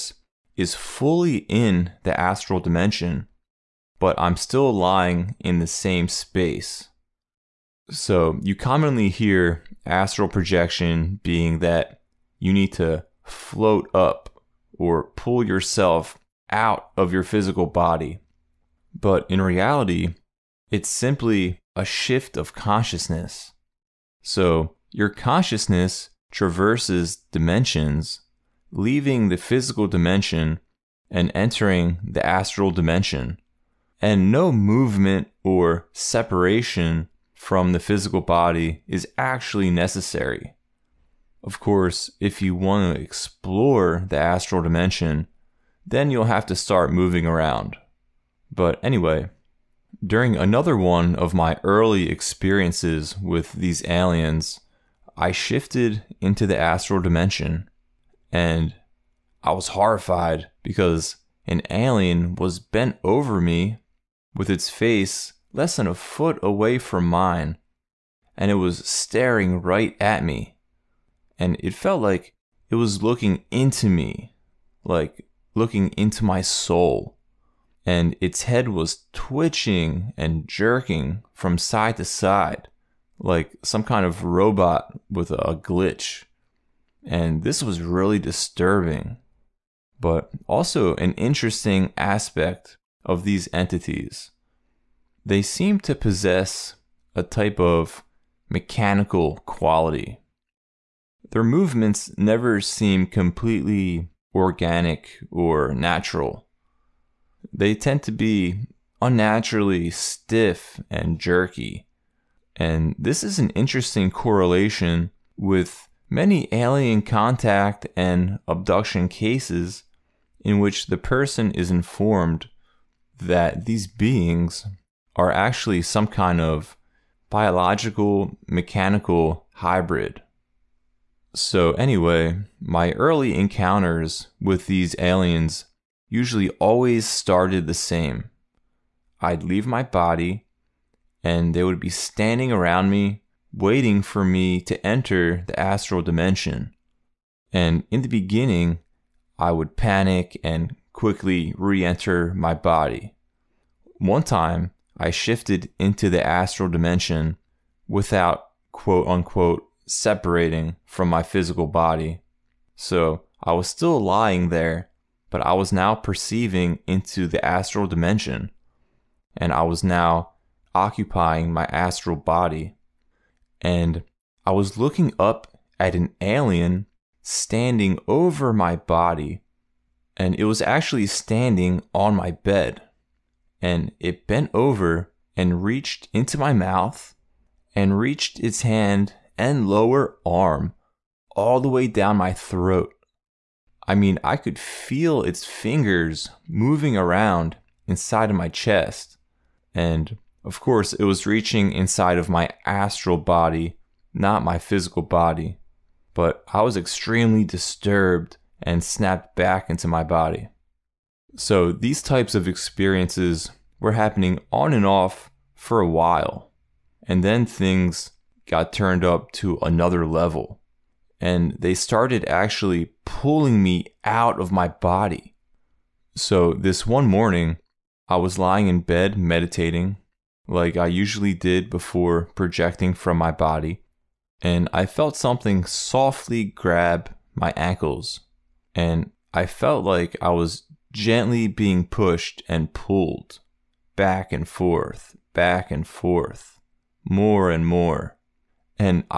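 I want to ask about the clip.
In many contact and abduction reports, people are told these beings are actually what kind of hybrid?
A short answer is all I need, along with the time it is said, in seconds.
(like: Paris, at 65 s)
biological mechanical hybrid, at 127 s.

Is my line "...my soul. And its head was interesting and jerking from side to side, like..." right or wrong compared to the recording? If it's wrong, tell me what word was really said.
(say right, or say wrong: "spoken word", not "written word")
wrong: "twitching", not "interesting".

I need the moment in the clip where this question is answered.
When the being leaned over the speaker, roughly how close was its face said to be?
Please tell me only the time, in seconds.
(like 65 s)
65 s.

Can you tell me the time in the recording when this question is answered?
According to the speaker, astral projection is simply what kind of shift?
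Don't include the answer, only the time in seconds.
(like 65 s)
21 s.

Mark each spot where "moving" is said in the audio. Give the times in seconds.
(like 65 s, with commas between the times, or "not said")
46 s, 196 s.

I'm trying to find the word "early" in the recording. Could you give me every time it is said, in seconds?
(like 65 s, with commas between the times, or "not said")
51 s, 132 s.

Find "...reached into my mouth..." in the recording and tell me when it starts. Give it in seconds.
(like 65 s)
185 s.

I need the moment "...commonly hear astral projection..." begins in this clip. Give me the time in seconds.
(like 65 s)
8 s.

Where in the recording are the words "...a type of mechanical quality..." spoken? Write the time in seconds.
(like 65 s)
97 s.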